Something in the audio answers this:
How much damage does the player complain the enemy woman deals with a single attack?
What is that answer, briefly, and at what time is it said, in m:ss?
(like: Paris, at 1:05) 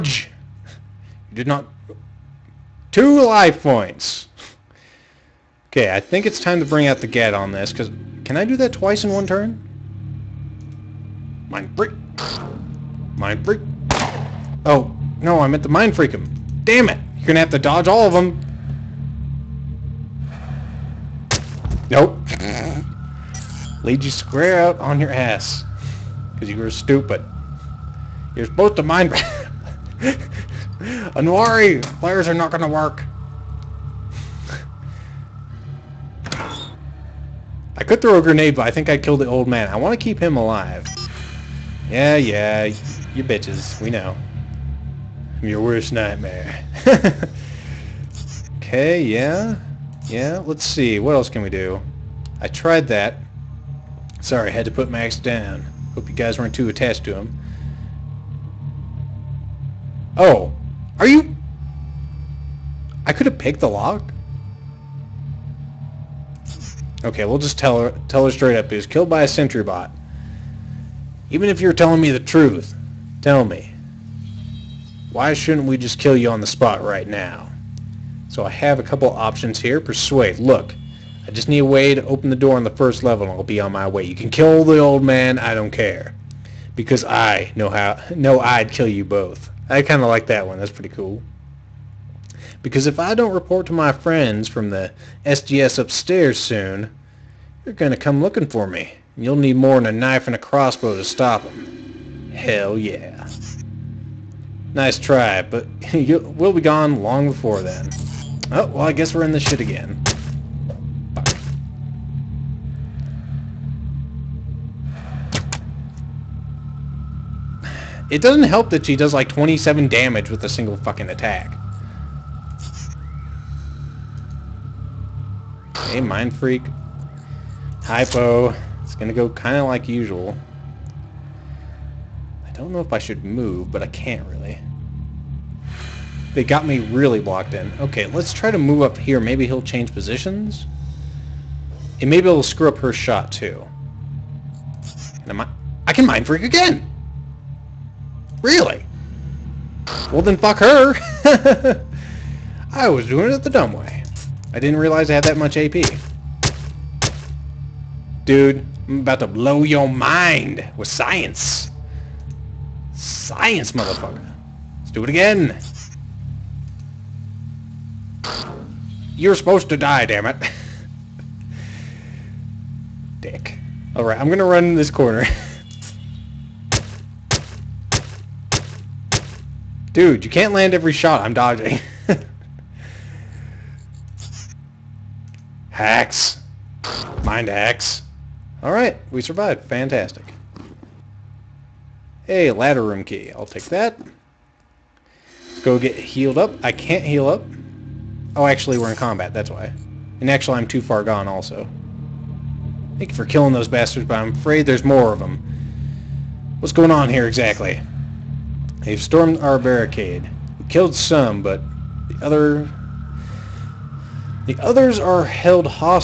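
27, at 1:59.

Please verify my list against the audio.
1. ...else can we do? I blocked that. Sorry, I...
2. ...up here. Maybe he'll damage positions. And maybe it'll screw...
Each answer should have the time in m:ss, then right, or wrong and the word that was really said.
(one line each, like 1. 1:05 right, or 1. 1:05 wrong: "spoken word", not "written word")
1. 0:51 wrong: "tried", not "blocked"
2. 2:18 wrong: "change", not "damage".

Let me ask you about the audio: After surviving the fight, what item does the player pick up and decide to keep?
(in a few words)
Ladder room key.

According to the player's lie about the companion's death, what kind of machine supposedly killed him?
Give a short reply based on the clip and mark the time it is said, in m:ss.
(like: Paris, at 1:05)
Sentry bot, at 1:09.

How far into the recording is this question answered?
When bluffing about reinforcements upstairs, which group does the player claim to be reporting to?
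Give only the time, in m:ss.
1:35.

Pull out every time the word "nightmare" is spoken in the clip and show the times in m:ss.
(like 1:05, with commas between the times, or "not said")
0:45.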